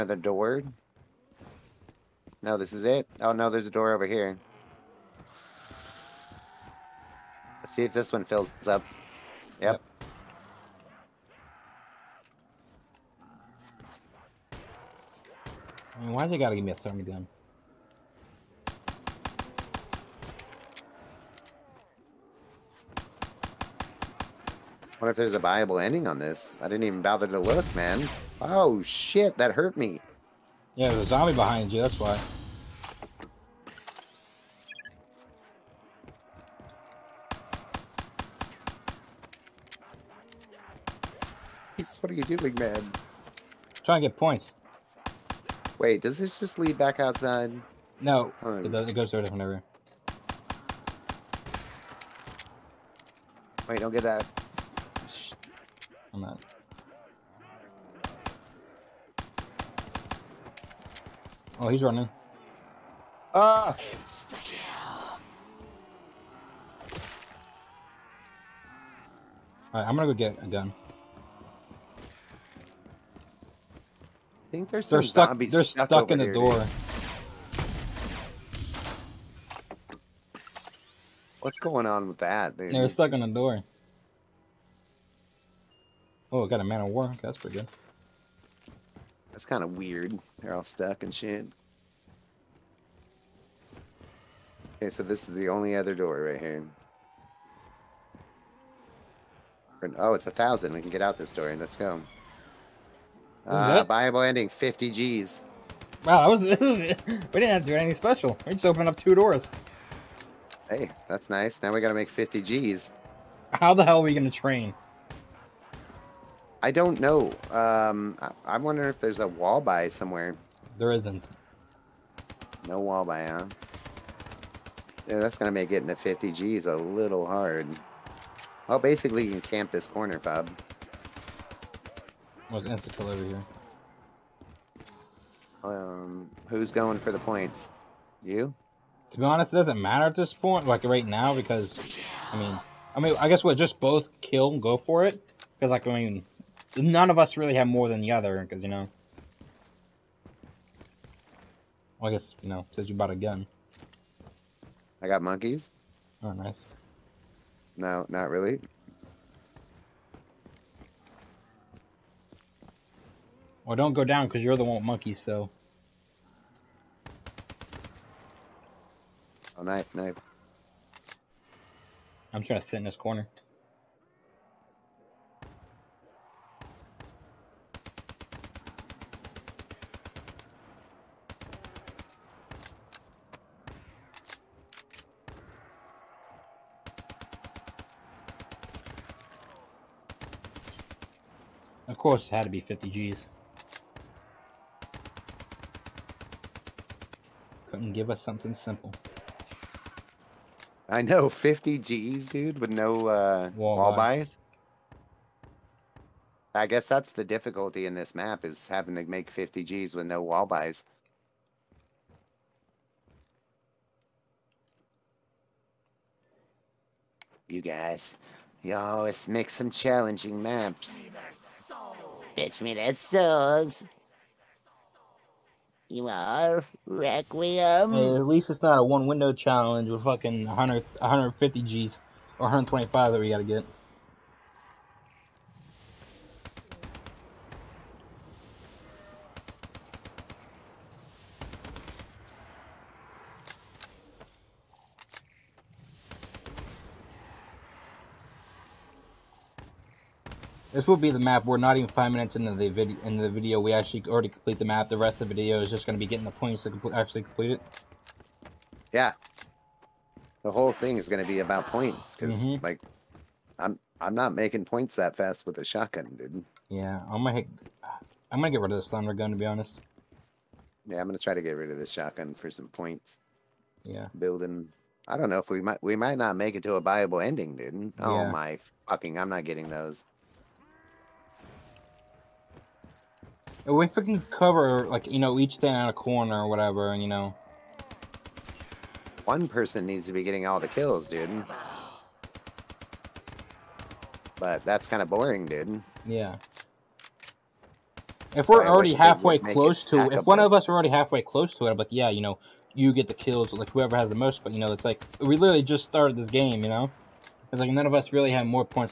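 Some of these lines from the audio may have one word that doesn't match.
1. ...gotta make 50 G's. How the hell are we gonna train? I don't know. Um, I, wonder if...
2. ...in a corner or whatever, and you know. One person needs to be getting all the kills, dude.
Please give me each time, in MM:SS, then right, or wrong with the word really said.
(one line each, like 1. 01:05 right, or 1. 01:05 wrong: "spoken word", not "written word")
1. 01:51 right
2. 04:45 right.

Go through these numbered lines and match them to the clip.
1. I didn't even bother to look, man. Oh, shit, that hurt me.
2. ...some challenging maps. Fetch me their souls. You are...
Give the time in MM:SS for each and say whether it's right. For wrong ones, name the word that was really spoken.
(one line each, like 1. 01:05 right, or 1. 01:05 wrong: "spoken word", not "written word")
1. 00:26 right
2. 03:39 right.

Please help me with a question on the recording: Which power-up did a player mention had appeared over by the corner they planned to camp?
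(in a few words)
Insta kill.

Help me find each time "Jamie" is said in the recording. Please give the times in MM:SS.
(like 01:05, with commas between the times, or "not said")
not said.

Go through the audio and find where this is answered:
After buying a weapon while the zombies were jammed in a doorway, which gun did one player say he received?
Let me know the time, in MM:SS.
01:26.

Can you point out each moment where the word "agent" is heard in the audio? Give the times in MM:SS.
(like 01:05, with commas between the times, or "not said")
not said.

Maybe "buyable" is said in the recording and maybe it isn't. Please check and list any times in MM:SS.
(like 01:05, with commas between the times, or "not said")
00:25, 01:43, 04:36.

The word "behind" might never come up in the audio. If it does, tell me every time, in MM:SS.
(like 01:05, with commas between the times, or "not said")
00:31.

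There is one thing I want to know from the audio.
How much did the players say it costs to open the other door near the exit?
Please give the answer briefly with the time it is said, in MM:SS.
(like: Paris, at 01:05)
1000, at 01:40.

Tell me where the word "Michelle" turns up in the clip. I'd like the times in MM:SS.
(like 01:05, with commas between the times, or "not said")
not said.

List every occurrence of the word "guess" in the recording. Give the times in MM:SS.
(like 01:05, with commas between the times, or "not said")
02:23, 02:32, 03:26.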